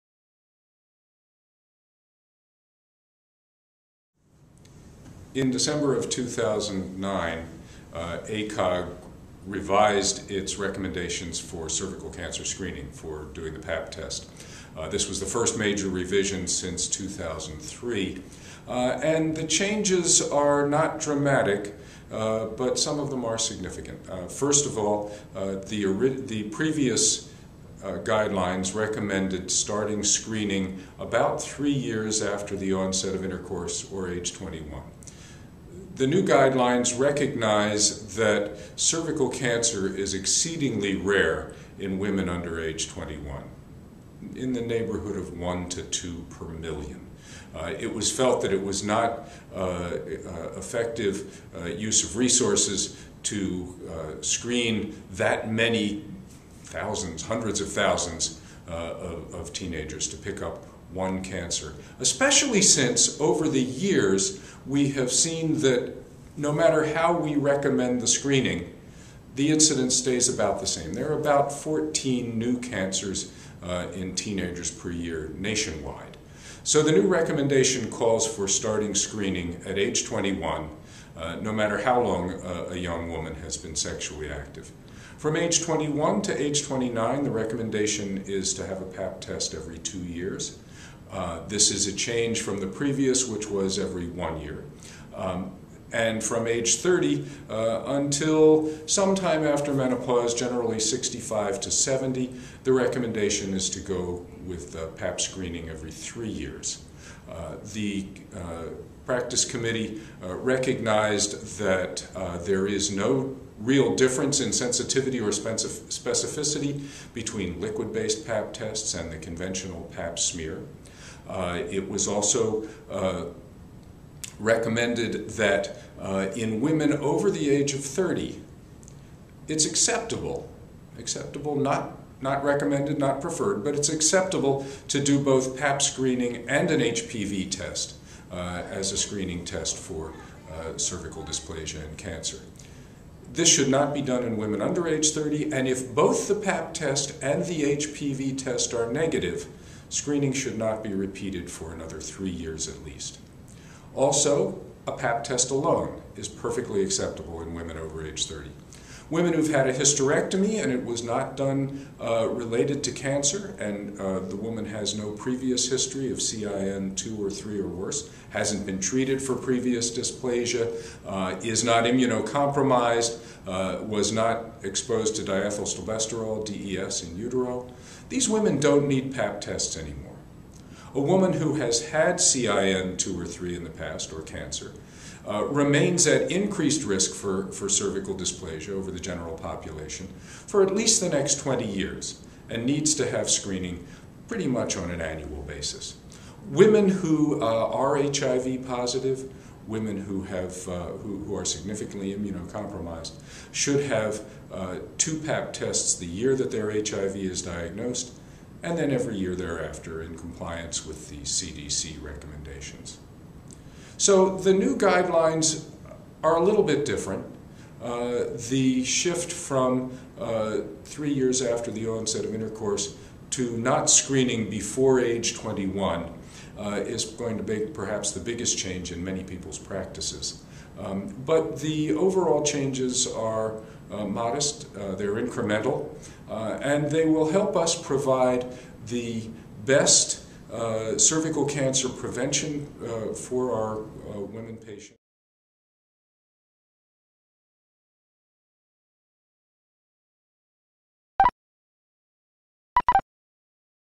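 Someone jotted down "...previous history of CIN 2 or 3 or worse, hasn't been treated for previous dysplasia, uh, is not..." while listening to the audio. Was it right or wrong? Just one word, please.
right.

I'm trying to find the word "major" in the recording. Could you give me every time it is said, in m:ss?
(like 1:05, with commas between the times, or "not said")
0:15.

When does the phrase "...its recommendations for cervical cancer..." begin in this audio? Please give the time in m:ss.
0:10.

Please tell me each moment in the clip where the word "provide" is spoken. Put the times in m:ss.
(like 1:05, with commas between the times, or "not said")
3:57.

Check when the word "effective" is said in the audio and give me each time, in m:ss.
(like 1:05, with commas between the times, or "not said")
0:50.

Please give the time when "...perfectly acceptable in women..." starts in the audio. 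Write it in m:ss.
2:36.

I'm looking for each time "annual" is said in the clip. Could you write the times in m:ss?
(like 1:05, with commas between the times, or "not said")
3:14.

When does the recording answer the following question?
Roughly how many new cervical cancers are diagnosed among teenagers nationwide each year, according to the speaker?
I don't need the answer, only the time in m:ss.
1:11.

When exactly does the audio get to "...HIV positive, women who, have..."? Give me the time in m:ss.
3:17.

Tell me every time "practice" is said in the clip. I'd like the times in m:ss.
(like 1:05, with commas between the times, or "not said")
1:49, 3:49.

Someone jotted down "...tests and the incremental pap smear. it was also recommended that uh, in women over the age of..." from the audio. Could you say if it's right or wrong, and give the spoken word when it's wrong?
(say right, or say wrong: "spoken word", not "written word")
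wrong: "conventional", not "incremental".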